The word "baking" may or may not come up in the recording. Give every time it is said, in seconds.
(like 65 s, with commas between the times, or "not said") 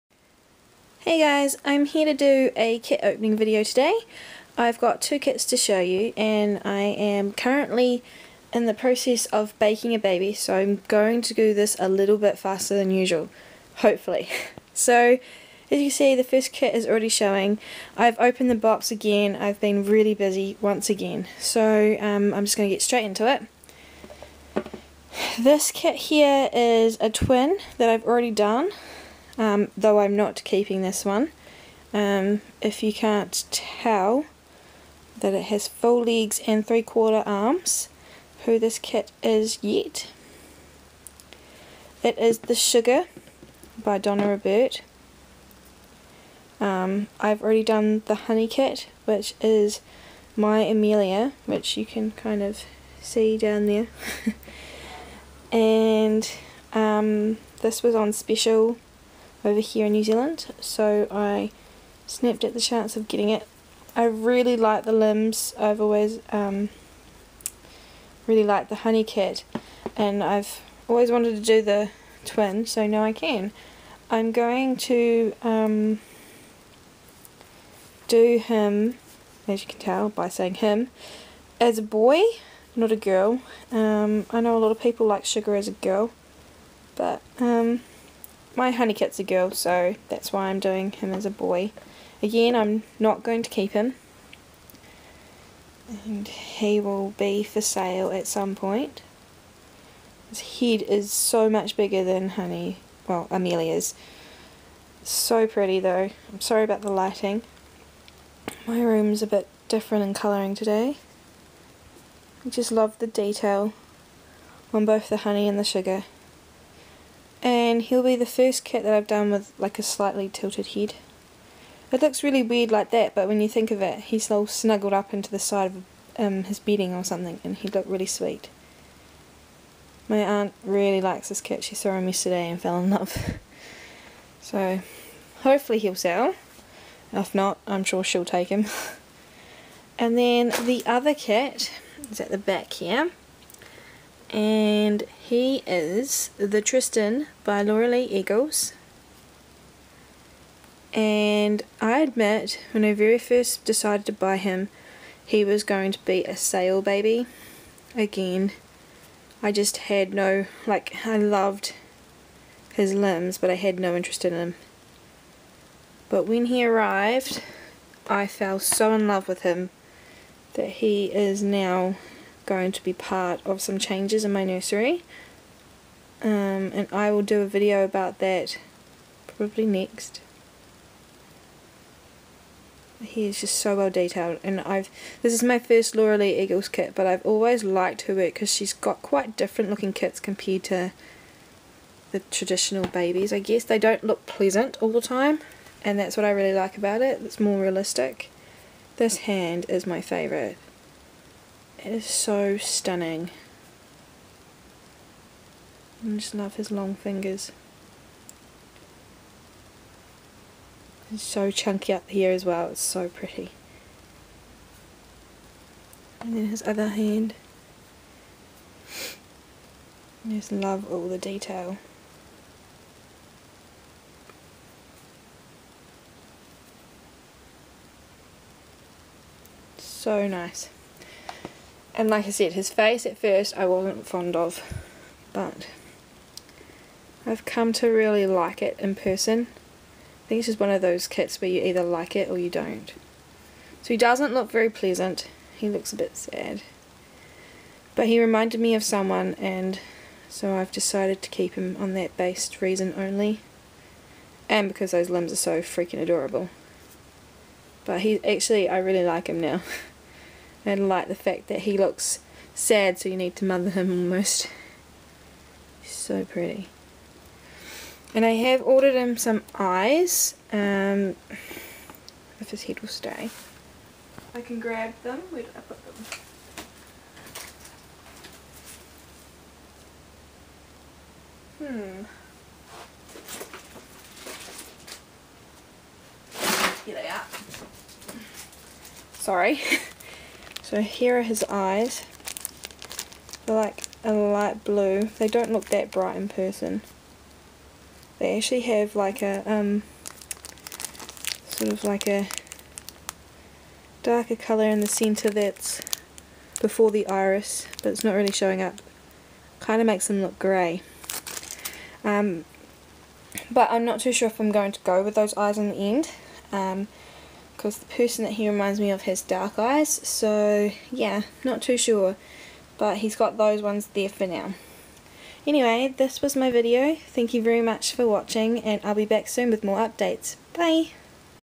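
9 s.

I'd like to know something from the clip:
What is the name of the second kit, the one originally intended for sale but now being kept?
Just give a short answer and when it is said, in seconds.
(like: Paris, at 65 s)
The Tristan, at 146 s.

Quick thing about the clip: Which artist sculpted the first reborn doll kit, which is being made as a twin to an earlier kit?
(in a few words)
Donna RuBert.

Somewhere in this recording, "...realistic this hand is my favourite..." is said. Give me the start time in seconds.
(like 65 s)
197 s.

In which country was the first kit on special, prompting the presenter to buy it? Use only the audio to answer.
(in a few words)
New Zealand.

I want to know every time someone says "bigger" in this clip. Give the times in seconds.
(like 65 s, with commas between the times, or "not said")
101 s.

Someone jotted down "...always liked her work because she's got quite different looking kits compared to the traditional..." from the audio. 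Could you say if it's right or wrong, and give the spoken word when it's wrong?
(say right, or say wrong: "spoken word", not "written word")
right.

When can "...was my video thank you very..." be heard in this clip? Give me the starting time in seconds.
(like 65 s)
326 s.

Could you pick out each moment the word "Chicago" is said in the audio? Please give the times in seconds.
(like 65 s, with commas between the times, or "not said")
not said.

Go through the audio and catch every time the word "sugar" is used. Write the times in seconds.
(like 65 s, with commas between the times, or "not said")
42 s, 85 s, 115 s.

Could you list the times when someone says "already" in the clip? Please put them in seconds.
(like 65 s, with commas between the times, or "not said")
16 s, 28 s, 47 s.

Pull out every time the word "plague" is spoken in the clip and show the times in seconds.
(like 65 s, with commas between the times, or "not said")
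not said.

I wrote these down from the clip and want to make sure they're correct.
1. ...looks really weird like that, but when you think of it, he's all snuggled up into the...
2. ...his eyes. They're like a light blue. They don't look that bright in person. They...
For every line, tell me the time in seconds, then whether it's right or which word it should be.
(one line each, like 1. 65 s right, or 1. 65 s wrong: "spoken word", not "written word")
1. 122 s right
2. 291 s right.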